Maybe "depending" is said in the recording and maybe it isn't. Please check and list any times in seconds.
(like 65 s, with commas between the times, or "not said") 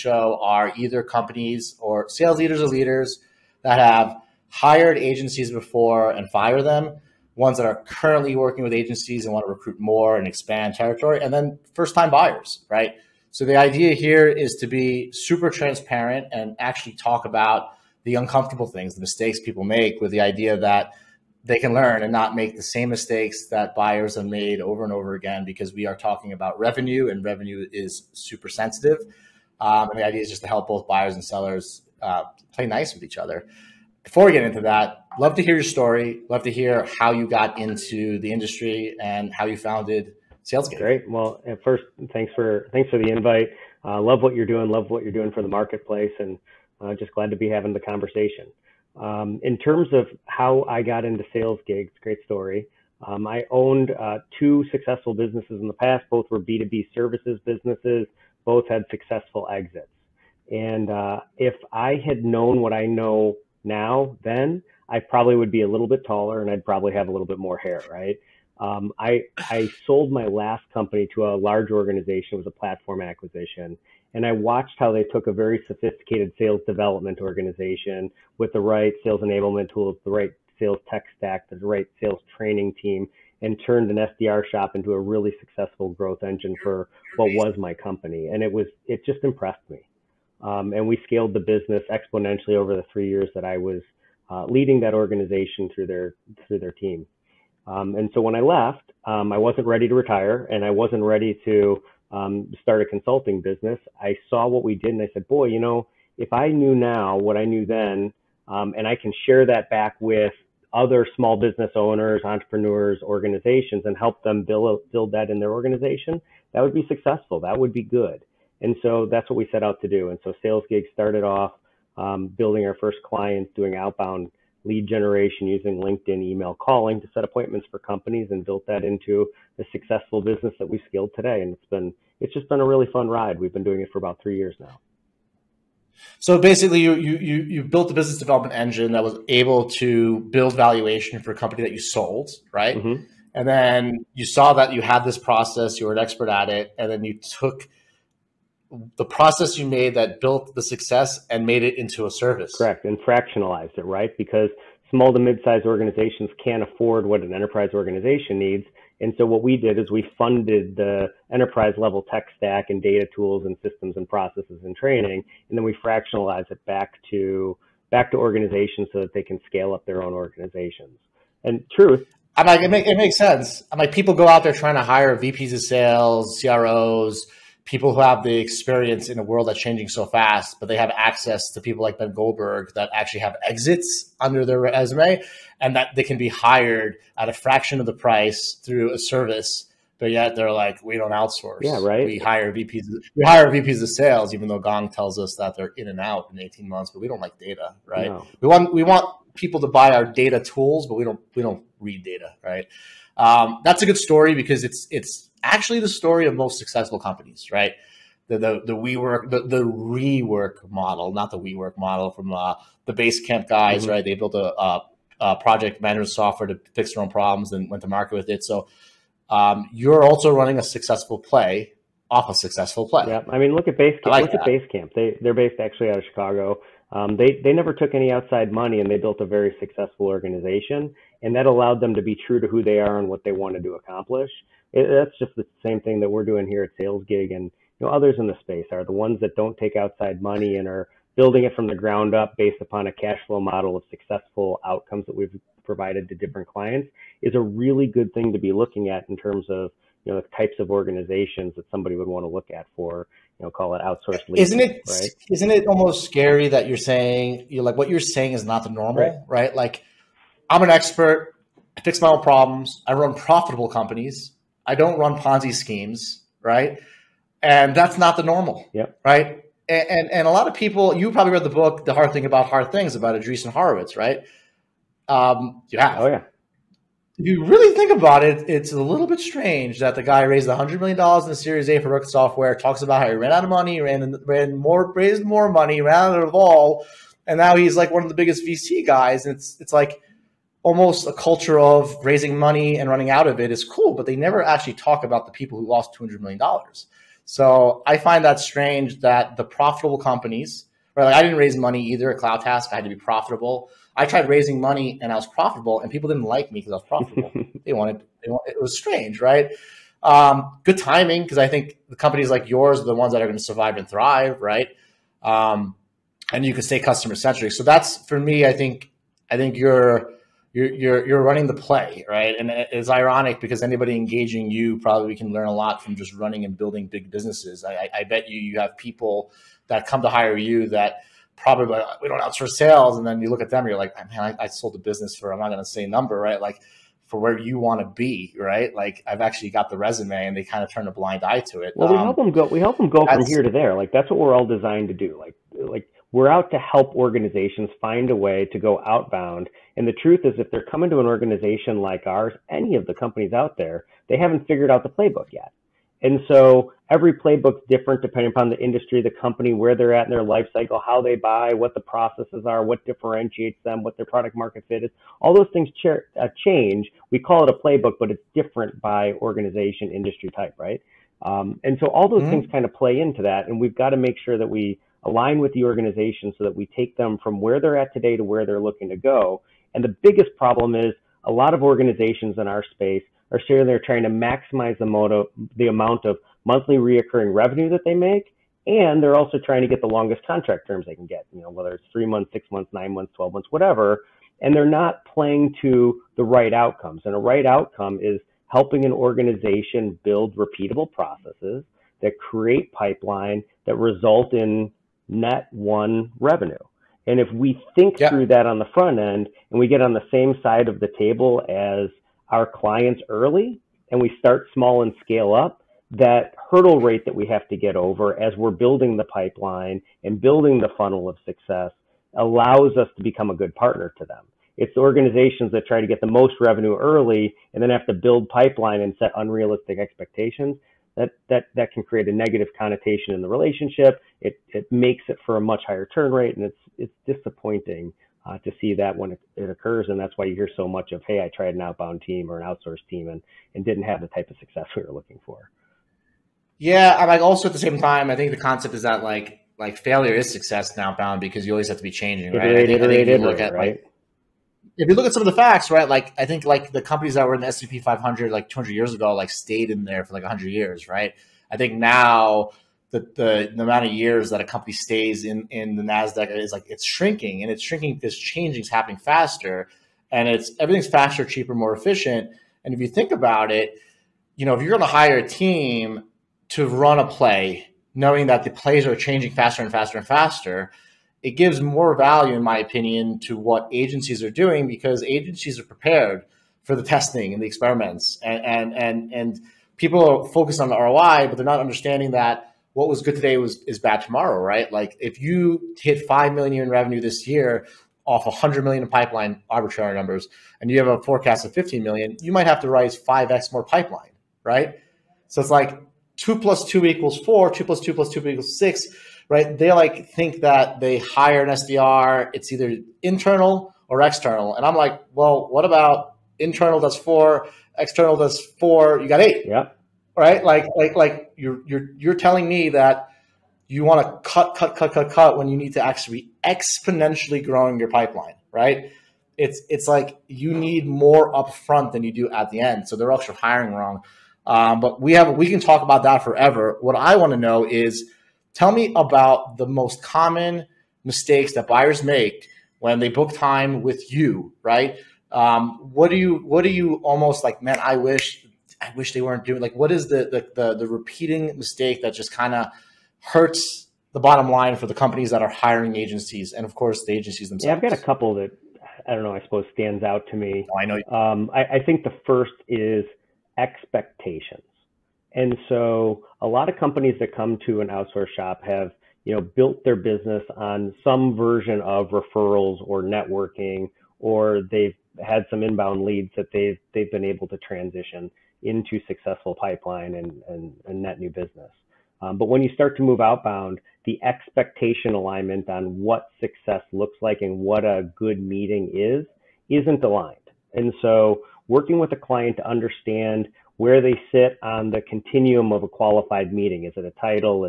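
358 s.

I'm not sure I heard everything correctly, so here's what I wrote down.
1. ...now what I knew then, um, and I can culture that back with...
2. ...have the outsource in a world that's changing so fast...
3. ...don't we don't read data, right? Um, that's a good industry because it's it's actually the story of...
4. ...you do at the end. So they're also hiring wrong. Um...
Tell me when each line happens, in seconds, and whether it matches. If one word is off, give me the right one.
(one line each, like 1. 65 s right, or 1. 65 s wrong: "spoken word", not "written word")
1. 106 s wrong: "share", not "culture"
2. 178 s wrong: "experience", not "outsource"
3. 201 s wrong: "story", not "industry"
4. 532 s right.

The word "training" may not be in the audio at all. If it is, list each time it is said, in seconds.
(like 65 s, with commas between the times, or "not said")
82 s, 164 s.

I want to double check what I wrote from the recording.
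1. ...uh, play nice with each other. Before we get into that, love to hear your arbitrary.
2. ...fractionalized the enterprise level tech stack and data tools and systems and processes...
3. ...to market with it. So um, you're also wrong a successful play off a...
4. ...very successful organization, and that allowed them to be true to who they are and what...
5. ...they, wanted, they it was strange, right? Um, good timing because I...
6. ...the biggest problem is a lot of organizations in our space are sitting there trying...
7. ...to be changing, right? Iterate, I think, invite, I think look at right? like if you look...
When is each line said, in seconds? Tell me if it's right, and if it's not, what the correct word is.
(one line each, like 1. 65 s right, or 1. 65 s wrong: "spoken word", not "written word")
1. 32 s wrong: "story", not "arbitrary"
2. 160 s wrong: "funded", not "fractionalized"
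3. 217 s wrong: "running", not "wrong"
4. 229 s right
5. 307 s right
6. 379 s right
7. 451 s wrong: "iterate", not "invite".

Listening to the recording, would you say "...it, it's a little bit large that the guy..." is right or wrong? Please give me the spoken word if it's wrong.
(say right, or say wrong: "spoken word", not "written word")
wrong: "strange", not "large".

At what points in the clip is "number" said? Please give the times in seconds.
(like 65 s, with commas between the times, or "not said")
335 s, 499 s.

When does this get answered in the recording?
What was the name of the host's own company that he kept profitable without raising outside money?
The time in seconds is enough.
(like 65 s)
302 s.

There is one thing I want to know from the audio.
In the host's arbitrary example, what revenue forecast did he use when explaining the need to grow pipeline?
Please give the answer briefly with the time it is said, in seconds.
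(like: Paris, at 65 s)
15 million, at 501 s.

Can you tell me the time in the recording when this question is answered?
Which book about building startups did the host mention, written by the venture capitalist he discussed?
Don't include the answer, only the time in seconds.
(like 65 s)
271 s.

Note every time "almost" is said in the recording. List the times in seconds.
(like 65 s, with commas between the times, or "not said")
255 s, 290 s, 546 s.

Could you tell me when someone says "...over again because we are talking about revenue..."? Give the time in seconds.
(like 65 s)
24 s.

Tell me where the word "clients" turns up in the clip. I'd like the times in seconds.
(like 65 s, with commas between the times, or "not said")
123 s, 246 s, 412 s, 592 s.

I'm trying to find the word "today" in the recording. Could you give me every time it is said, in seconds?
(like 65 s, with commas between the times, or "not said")
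131 s, 377 s, 493 s.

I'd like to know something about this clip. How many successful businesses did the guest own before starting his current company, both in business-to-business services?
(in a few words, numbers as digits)
2.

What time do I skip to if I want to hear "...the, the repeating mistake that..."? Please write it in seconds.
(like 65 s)
550 s.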